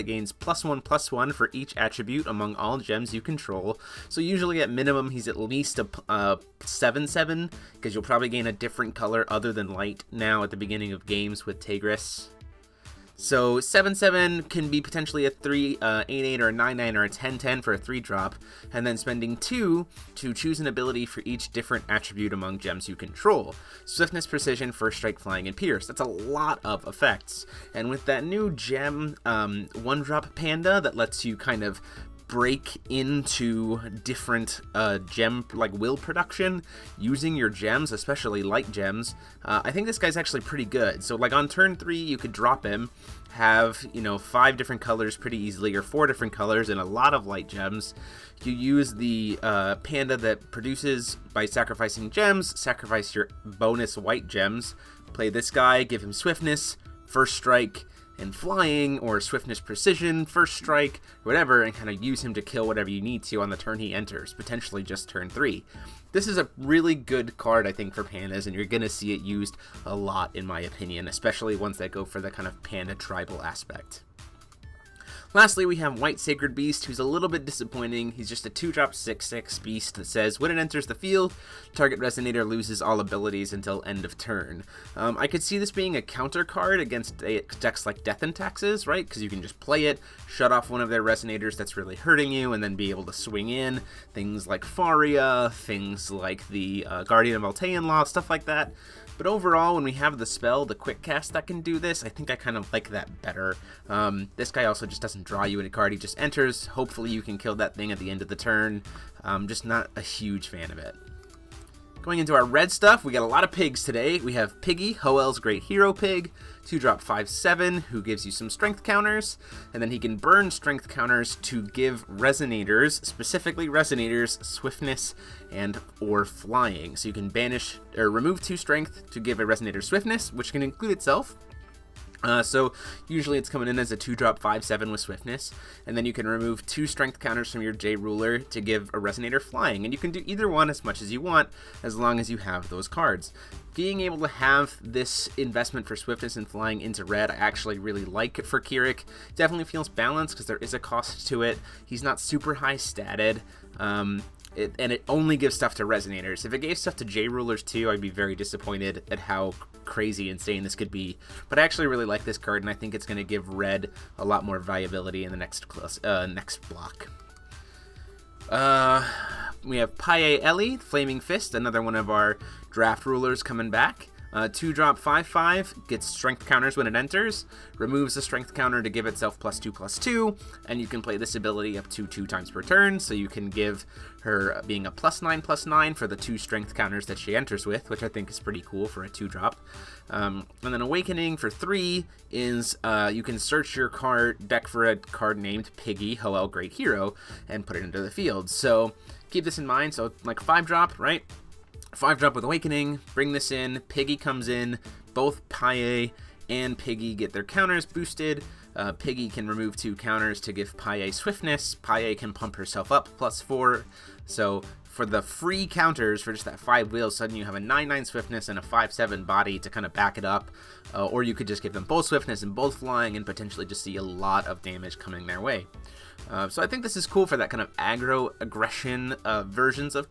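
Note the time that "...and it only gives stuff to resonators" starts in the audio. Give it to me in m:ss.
2:34.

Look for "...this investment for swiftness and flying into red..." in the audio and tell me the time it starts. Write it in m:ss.
2:24.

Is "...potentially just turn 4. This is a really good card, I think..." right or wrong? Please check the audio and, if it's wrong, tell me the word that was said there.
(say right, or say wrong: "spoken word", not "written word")
wrong: "3", not "4".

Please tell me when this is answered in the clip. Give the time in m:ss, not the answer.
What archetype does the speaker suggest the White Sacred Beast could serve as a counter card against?
1:28.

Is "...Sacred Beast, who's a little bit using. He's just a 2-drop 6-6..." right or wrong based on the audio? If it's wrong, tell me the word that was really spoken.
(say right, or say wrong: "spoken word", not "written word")
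wrong: "disappointing", not "using".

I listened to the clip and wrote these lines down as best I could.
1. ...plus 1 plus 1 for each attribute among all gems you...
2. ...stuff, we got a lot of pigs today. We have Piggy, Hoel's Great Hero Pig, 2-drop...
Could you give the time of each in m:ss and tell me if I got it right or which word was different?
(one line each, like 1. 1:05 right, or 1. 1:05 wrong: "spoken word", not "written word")
1. 0:00 right
2. 1:52 right.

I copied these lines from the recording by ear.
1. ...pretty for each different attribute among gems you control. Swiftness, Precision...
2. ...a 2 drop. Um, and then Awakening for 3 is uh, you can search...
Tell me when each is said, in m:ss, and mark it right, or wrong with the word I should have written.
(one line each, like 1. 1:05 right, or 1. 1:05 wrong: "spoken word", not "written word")
1. 0:20 wrong: "ability", not "pretty"
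2. 3:09 right.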